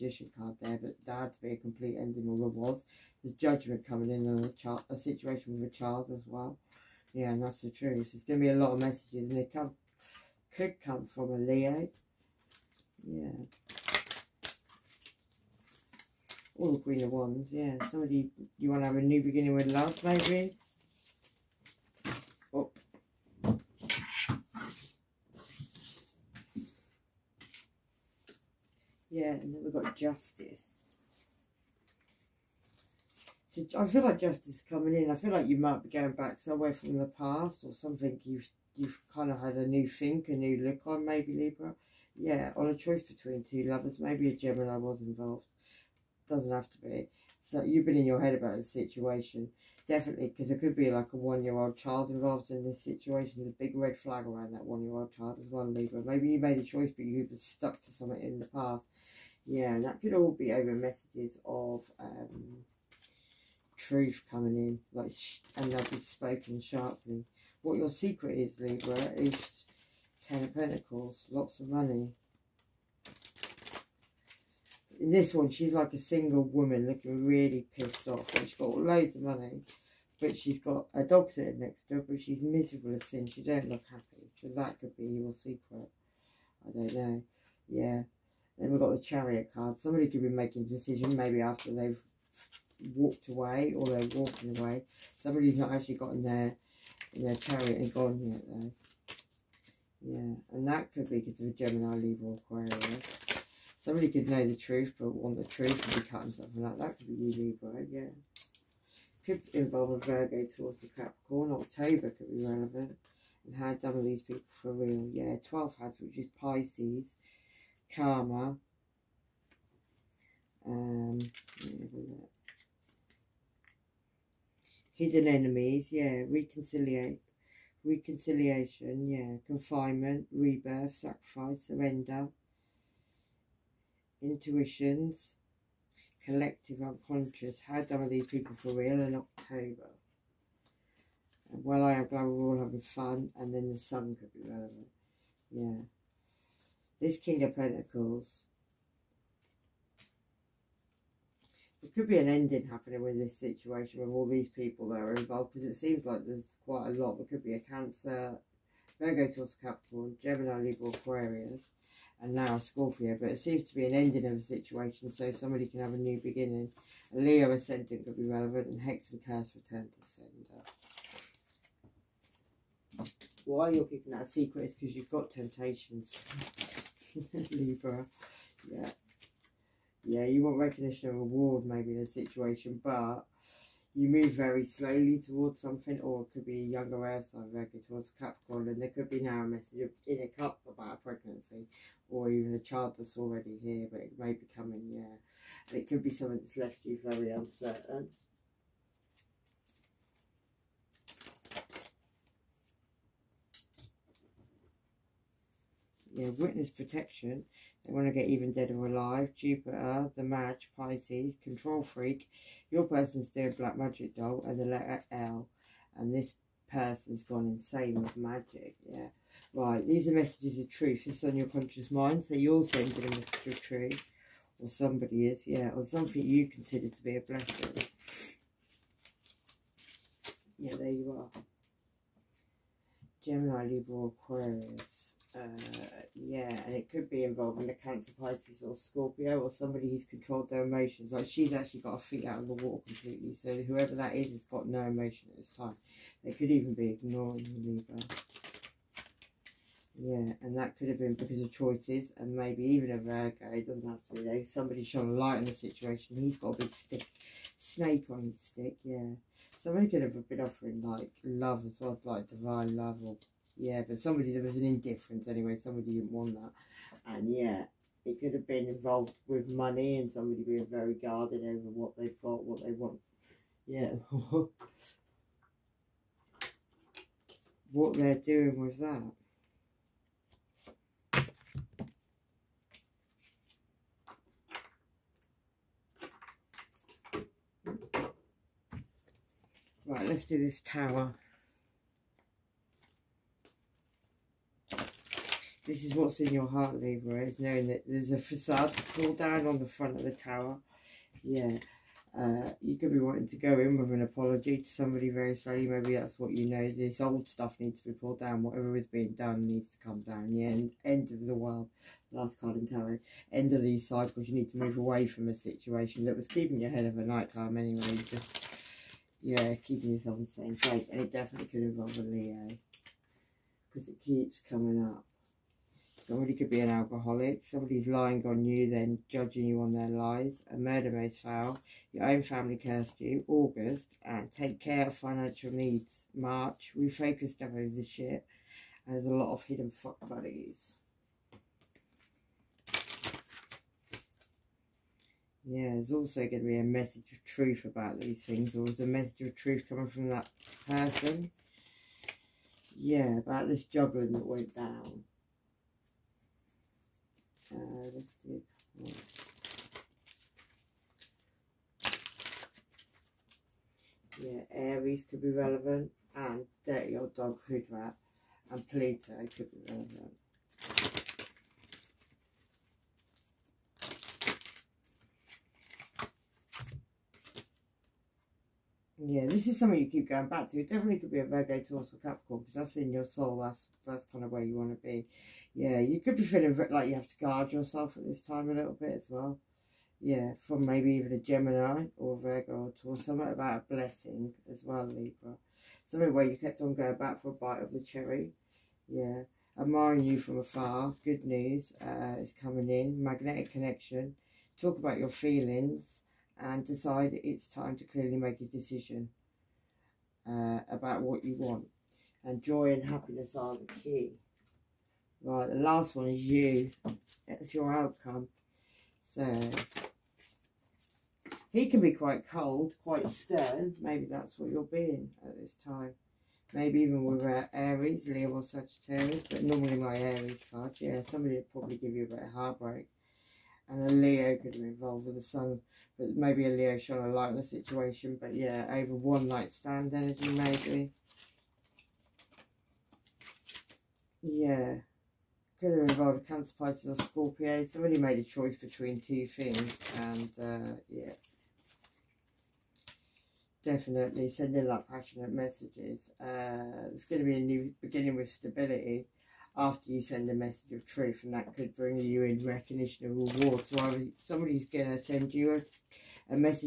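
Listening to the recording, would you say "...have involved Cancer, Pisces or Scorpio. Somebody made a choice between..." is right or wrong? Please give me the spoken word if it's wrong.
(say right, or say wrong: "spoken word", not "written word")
right.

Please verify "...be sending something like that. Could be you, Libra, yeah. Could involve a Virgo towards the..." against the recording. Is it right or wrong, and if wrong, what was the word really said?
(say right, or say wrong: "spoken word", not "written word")
wrong: "cutting", not "sending".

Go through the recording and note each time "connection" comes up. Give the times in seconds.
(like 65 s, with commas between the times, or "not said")
403 s.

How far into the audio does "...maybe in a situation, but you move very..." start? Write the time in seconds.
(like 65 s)
181 s.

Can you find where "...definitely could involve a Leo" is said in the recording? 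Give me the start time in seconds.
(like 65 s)
321 s.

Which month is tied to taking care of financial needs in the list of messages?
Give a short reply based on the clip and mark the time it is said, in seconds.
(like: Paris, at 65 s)
March, at 336 s.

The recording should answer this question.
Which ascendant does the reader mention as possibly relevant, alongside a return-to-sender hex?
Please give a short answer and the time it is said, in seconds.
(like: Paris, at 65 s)
Leo ascendant, at 167 s.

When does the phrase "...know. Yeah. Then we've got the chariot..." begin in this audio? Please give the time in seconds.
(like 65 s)
86 s.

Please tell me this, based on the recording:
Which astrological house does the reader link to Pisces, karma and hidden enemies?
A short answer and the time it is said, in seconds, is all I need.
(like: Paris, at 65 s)
12th house, at 115 s.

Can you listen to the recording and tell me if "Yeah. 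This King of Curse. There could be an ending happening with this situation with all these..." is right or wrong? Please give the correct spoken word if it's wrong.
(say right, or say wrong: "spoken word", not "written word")
wrong: "Pentacles", not "Curse".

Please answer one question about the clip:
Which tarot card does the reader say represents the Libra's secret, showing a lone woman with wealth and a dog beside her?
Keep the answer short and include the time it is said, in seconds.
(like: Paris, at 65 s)
Ten of Pentacles, at 70 s.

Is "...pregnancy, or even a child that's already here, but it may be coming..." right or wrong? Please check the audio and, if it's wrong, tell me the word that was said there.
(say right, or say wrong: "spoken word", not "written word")
right.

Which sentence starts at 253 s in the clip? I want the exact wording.
It doesn't have to be there.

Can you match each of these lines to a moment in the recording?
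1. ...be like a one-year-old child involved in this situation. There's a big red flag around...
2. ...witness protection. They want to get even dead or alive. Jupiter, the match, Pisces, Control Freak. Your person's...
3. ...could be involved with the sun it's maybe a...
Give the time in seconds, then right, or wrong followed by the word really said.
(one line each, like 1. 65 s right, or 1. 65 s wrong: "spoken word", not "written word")
1. 50 s right
2. 206 s right
3. 434 s right.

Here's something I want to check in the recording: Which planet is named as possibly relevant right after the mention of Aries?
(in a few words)
Pluto.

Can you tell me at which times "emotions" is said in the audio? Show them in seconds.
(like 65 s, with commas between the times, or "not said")
240 s, 244 s.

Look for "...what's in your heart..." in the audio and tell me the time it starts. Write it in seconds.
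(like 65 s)
295 s.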